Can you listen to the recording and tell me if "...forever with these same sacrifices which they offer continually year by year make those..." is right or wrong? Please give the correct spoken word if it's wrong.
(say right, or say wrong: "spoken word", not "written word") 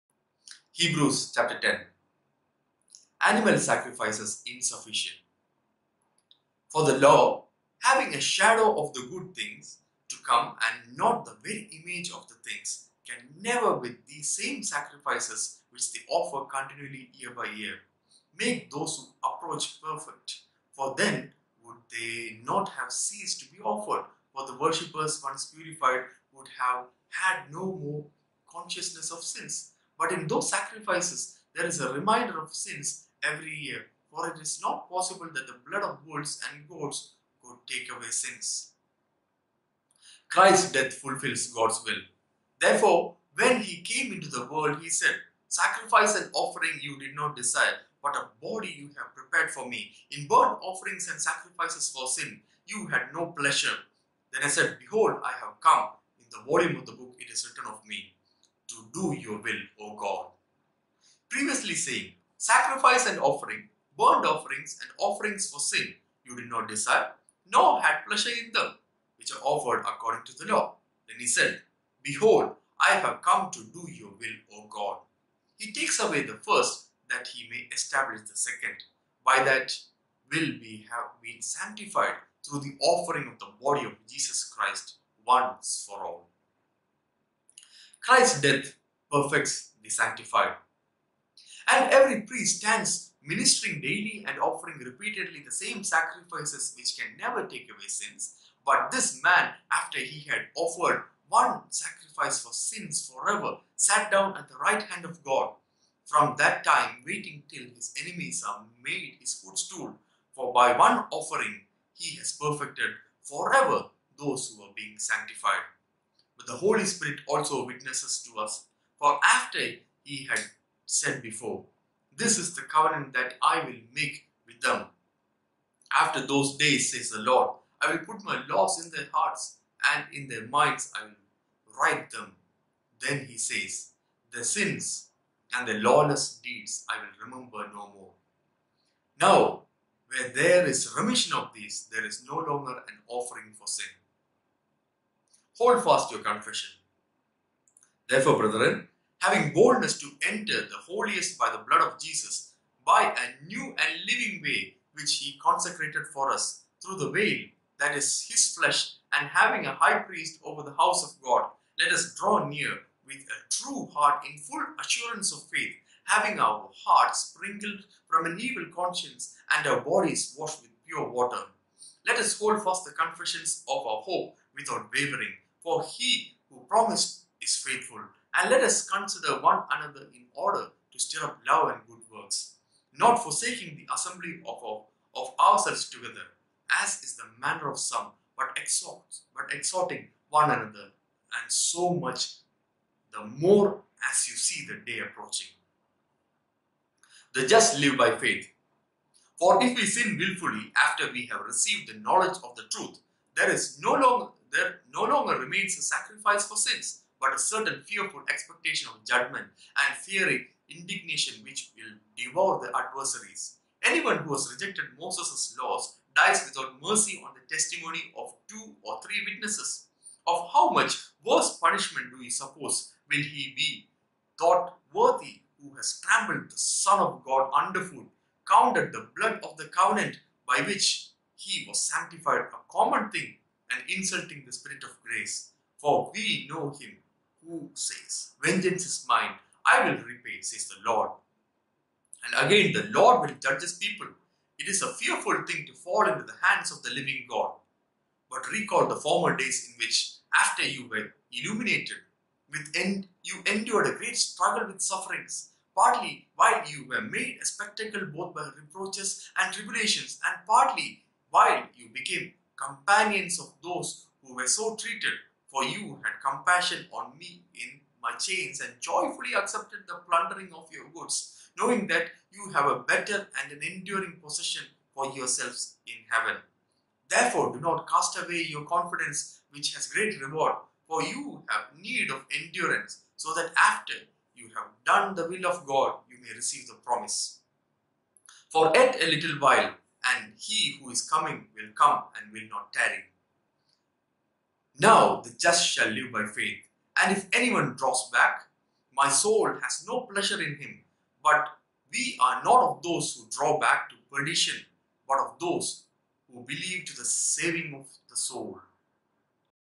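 wrong: "never", not "forever".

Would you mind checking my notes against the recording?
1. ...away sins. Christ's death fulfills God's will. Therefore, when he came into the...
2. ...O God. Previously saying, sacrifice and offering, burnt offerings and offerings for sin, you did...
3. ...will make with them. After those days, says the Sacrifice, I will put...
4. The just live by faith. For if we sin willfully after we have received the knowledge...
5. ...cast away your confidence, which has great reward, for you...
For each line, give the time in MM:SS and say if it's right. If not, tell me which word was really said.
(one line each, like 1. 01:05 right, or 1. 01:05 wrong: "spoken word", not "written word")
1. 00:37 right
2. 00:59 right
3. 02:03 wrong: "Lord", not "Sacrifice"
4. 03:17 right
5. 04:37 right.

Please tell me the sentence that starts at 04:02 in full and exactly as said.
And again, the Lord will judge his people.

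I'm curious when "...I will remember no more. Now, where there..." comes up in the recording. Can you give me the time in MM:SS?
02:16.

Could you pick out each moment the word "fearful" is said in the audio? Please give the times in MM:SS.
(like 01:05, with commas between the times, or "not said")
03:27, 04:04.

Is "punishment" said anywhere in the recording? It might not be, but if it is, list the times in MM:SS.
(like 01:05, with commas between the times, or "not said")
03:41.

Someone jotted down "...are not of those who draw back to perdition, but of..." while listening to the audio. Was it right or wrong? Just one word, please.
right.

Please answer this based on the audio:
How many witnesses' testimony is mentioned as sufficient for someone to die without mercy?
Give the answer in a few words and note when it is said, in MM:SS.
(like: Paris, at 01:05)
2 or 3, at 03:38.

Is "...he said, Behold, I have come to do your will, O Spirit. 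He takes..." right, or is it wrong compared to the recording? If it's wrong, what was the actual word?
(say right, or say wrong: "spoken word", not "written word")
wrong: "God", not "Spirit".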